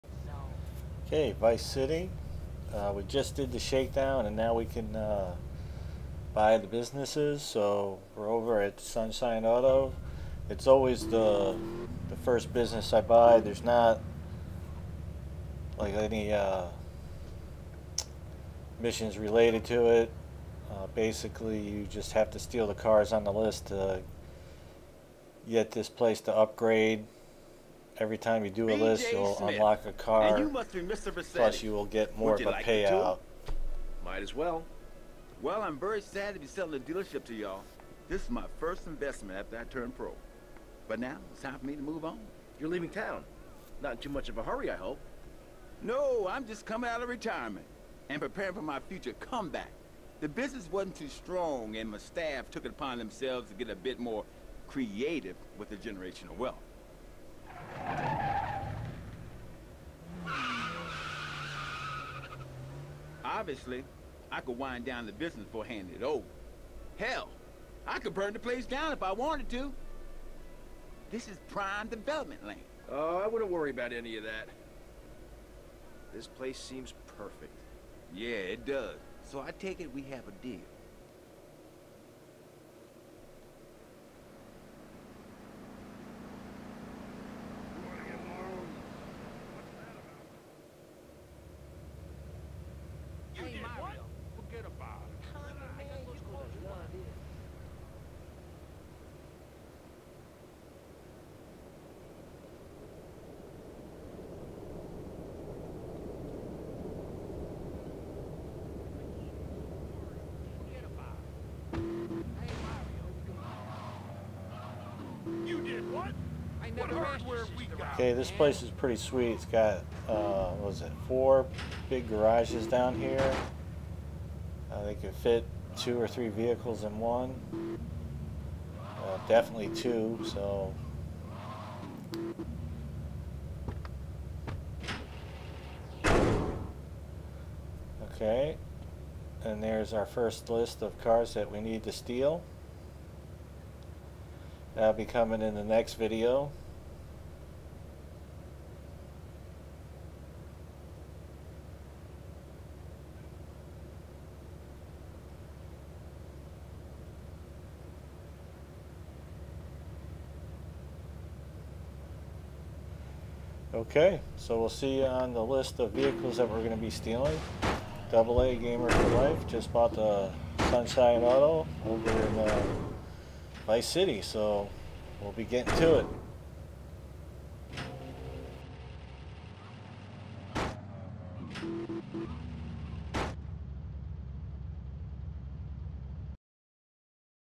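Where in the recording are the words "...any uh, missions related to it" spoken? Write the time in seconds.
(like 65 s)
15 s.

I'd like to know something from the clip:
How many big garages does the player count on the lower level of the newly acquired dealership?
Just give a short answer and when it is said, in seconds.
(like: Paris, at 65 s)
4, at 121 s.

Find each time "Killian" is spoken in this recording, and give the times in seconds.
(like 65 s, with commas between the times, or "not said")
not said.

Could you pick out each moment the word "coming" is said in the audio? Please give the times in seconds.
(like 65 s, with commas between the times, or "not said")
46 s, 145 s.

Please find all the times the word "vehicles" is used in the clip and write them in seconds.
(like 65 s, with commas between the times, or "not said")
126 s, 165 s.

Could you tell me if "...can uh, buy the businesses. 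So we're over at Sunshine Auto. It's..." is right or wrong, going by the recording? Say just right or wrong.
right.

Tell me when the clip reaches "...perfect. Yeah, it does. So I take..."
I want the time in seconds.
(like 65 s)
77 s.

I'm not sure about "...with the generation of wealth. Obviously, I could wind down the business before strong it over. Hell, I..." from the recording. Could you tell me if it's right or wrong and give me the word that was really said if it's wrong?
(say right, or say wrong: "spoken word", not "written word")
wrong: "handing", not "strong".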